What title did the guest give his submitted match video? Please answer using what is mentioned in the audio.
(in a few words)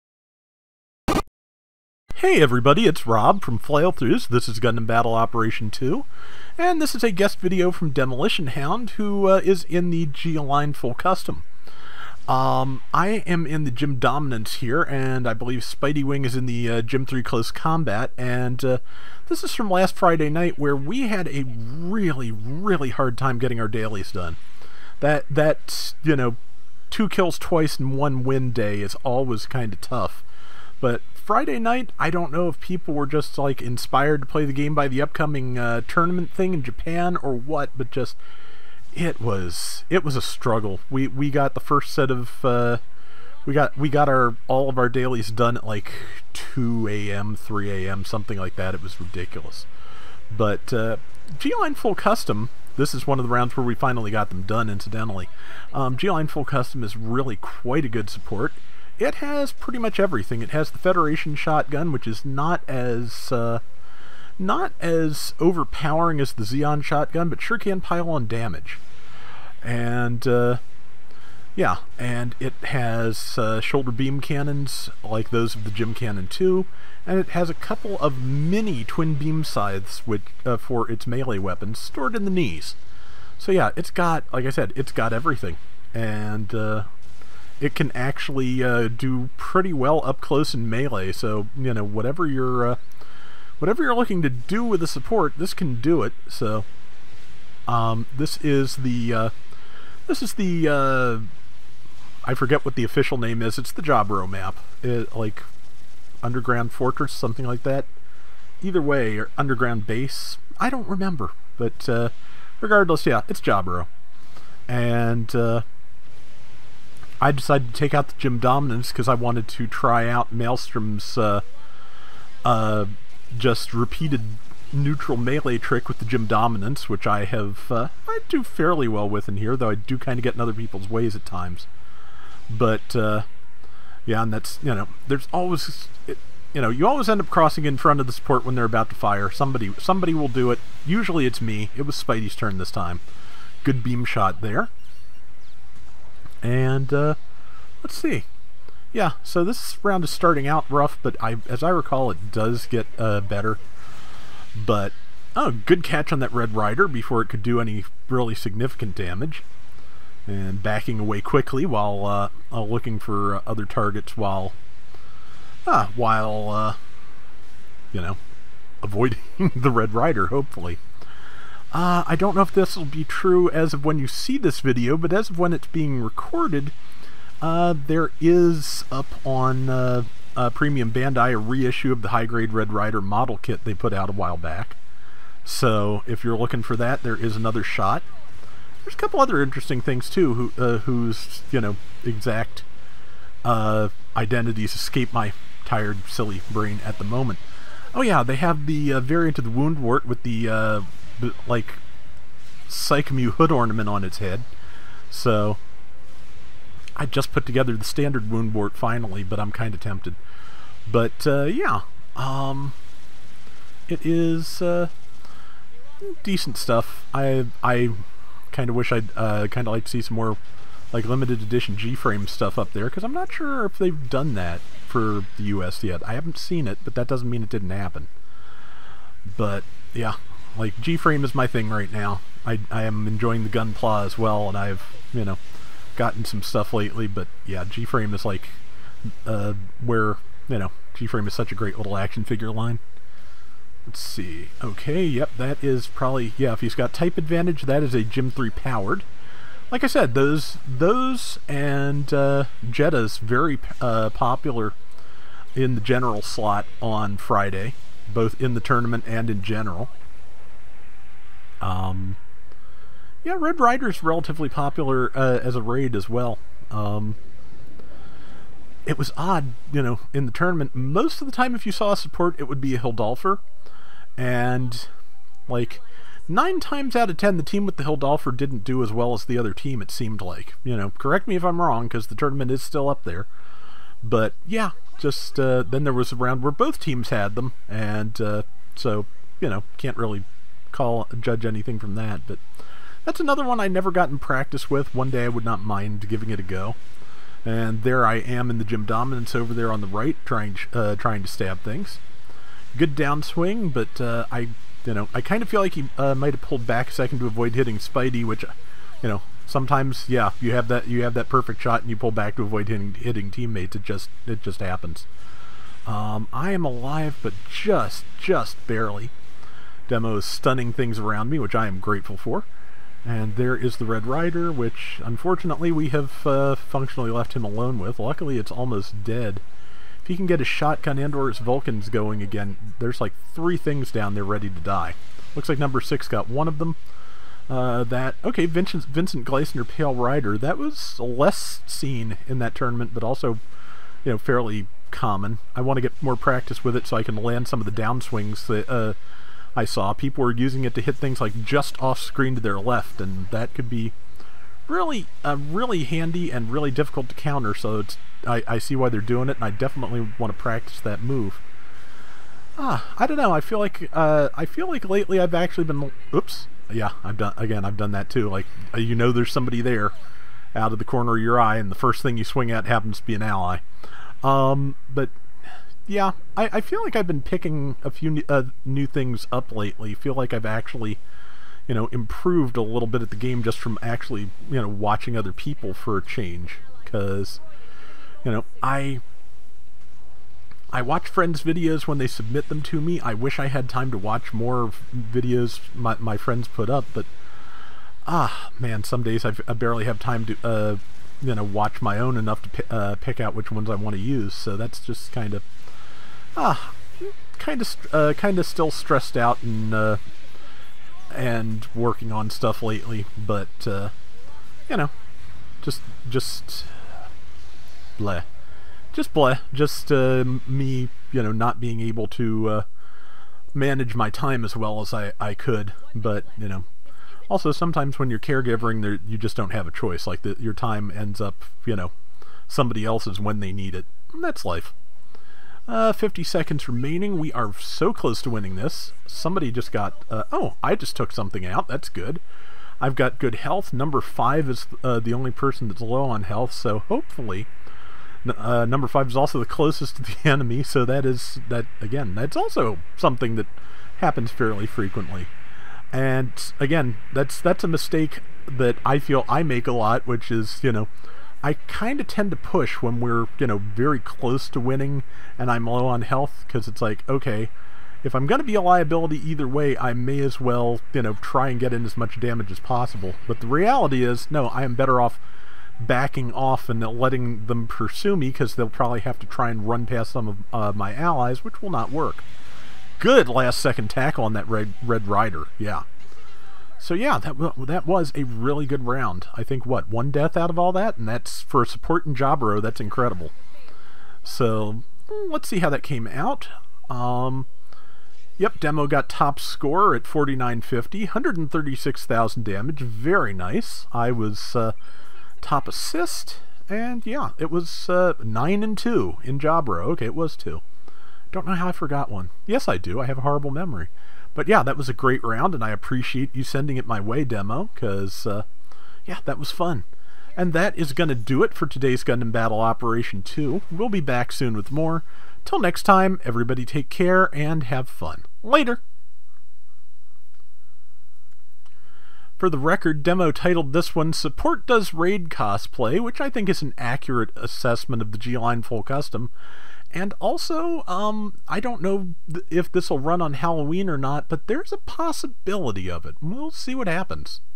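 Support Does Raid Cosplay.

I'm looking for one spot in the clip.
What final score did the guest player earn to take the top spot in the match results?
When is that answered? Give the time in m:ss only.
8:20.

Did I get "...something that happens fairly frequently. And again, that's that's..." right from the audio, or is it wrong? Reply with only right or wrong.
right.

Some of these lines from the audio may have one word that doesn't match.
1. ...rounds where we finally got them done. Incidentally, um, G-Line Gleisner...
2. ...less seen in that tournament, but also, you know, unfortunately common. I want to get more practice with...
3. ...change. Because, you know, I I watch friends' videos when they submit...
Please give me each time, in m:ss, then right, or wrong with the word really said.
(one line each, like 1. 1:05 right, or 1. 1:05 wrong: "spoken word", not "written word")
1. 0:53 wrong: "Full", not "Gleisner"
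2. 5:41 wrong: "fairly", not "unfortunately"
3. 6:26 right.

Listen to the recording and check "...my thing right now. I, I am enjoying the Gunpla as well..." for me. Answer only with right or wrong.
right.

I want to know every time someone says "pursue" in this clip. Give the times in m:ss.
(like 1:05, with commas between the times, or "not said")
7:57.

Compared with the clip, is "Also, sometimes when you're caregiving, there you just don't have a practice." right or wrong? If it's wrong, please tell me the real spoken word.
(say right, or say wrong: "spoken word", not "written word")
wrong: "choice", not "practice".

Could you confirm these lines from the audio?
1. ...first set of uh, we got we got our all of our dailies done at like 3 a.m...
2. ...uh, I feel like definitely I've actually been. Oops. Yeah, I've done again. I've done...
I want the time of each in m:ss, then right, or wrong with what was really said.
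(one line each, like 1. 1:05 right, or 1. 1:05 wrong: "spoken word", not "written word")
1. 0:41 wrong: "2", not "3"
2. 6:03 wrong: "lately", not "definitely".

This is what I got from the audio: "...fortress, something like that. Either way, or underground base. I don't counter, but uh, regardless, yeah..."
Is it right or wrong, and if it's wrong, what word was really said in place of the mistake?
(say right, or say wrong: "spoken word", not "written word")
wrong: "remember", not "counter".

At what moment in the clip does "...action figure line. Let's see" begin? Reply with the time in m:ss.
4:01.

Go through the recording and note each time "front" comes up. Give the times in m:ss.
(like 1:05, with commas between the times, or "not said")
2:17.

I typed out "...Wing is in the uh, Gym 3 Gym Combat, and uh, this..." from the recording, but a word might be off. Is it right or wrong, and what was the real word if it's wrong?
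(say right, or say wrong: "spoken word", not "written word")
wrong: "Close", not "Gym".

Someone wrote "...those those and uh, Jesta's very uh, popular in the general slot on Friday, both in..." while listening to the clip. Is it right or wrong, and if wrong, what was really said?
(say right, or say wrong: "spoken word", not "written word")
right.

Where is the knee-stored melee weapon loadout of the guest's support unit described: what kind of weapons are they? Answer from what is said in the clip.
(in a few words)
mini twin beam scythes.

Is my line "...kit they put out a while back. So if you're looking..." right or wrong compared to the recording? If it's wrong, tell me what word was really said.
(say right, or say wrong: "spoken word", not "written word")
right.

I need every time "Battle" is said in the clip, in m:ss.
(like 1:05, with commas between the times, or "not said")
0:04, 8:42.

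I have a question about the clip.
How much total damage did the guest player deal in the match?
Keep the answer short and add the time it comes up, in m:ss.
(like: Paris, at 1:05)
136,000, at 8:21.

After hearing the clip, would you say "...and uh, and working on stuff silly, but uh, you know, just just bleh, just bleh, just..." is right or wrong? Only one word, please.
wrong.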